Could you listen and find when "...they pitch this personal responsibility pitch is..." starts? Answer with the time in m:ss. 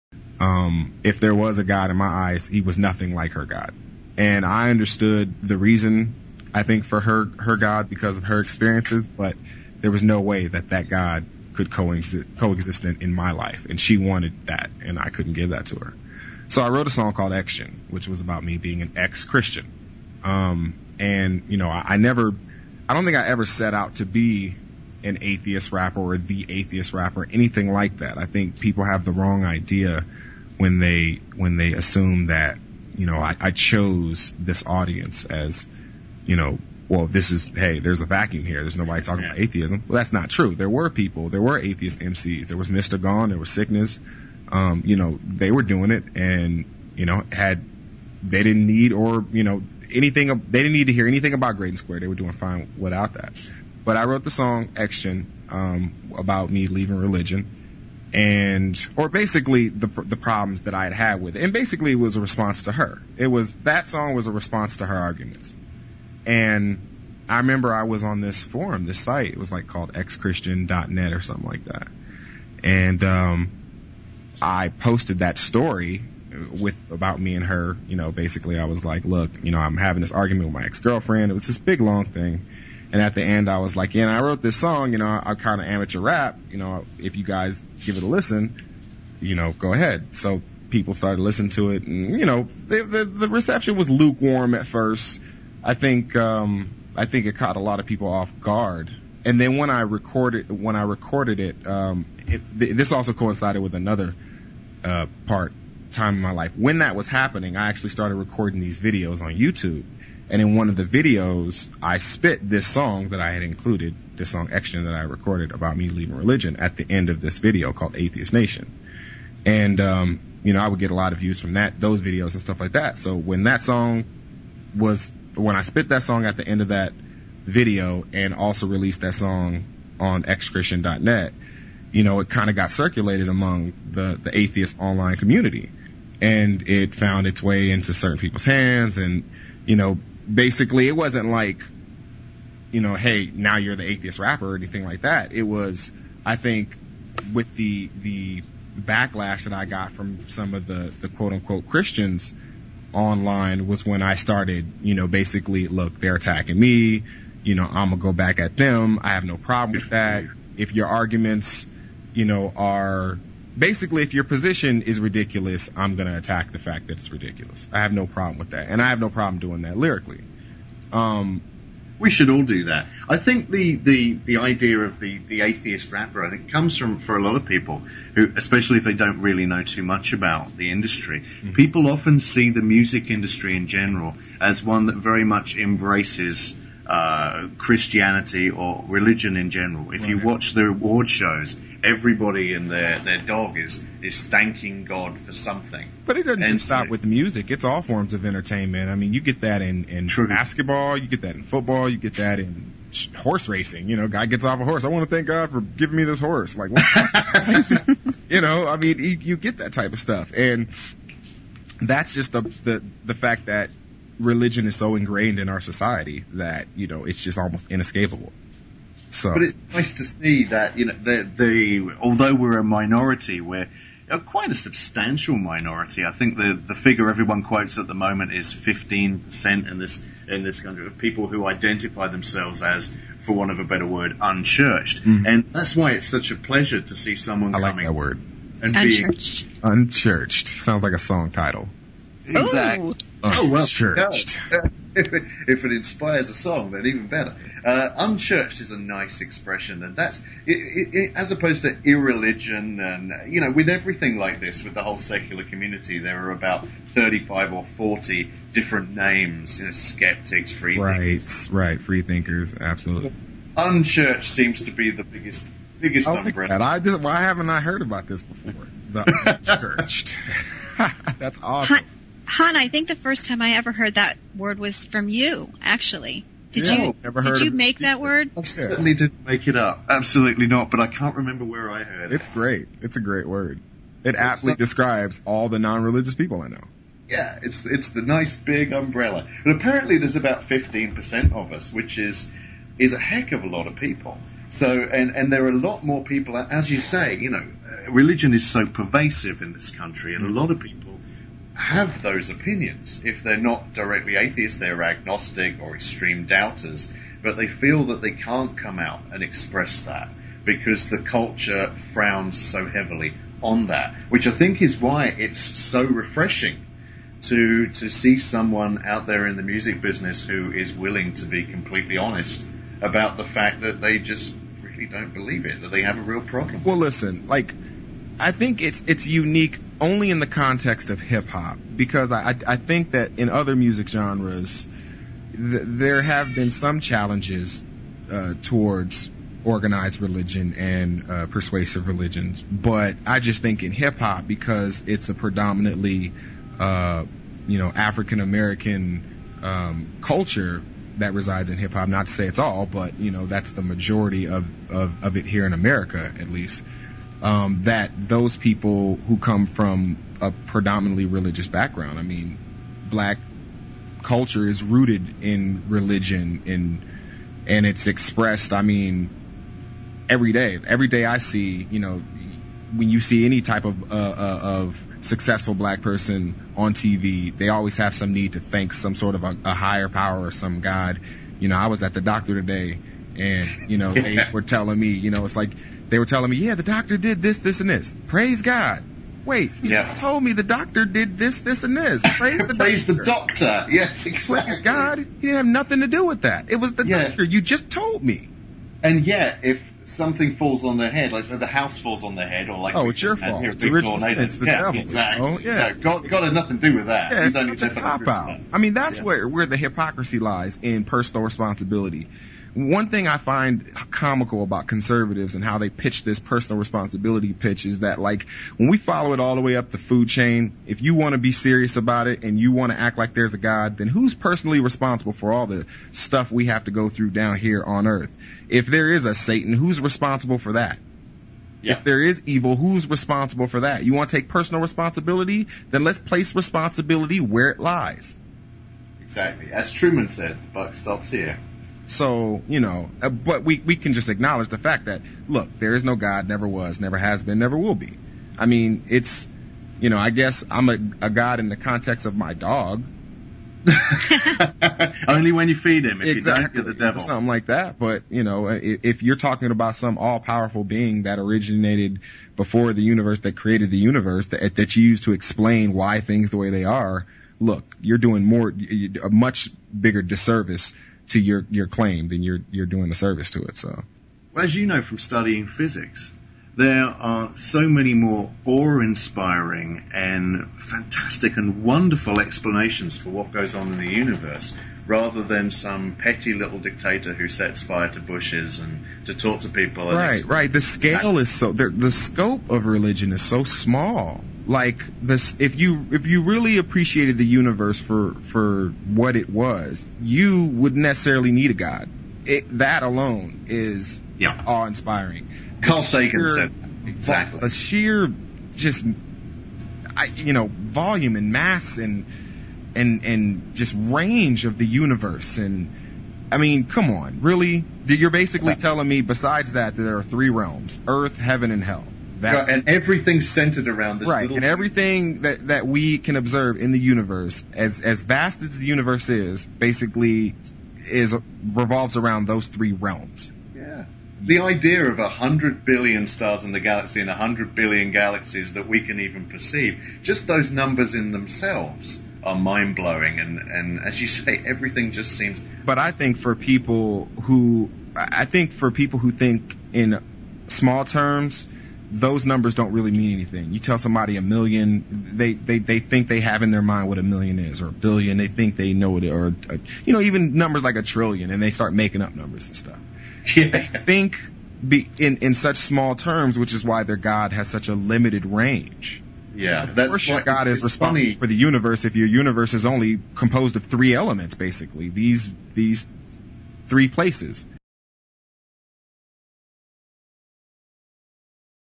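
6:55.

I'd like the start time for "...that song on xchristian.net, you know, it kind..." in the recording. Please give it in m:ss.
2:09.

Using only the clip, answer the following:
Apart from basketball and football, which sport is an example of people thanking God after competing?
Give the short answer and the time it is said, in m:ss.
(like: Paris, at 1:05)
Horse racing, at 3:23.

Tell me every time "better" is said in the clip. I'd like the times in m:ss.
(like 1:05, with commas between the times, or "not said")
3:53, 4:07.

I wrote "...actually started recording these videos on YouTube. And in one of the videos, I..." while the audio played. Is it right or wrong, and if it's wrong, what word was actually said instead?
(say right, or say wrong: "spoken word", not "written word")
right.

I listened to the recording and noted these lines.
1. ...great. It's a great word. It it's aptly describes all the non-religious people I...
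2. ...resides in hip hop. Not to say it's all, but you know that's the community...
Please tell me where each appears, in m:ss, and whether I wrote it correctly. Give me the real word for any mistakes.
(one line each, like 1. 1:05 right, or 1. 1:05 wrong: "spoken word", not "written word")
1. 4:42 right
2. 5:51 wrong: "majority", not "community".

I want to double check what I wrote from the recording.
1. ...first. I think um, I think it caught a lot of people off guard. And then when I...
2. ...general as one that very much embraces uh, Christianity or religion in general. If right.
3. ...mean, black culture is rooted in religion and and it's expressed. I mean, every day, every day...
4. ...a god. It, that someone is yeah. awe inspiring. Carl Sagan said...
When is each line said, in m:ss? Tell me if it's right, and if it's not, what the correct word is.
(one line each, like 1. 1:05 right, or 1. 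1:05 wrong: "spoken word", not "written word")
1. 1:34 right
2. 3:03 right
3. 6:02 right
4. 8:21 wrong: "alone", not "someone".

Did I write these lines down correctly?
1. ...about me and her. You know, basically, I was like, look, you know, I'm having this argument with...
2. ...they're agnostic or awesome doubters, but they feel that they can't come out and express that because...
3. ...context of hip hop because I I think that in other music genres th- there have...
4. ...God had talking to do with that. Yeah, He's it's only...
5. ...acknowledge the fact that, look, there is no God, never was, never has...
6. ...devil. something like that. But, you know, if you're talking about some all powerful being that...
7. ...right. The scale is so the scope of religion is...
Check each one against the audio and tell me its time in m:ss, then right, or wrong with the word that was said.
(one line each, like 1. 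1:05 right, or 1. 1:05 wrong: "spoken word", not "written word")
1. 1:16 right
2. 5:04 wrong: "extreme", not "awesome"
3. 5:30 right
4. 6:46 wrong: "nothing", not "talking"
5. 7:24 right
6. 7:36 right
7. 8:10 right.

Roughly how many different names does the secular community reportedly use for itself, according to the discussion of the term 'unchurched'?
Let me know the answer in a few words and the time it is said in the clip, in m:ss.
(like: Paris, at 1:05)
35 or 40, at 4:16.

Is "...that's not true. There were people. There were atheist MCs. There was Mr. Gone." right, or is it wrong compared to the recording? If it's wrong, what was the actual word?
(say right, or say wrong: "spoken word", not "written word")
right.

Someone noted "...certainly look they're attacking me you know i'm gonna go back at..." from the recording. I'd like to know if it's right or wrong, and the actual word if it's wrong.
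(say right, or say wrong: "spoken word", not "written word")
wrong: "basically", not "certainly".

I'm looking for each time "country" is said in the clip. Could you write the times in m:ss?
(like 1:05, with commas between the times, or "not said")
3:50, 4:59.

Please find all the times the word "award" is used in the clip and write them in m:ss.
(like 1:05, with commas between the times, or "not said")
3:10.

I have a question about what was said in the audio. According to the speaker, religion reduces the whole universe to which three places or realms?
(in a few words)
Earth, Heaven, and Hell.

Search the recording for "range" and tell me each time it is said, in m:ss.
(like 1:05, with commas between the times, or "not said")
8:33, 9:28.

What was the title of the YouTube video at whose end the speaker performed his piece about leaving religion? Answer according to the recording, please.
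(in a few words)
Atheist Nation.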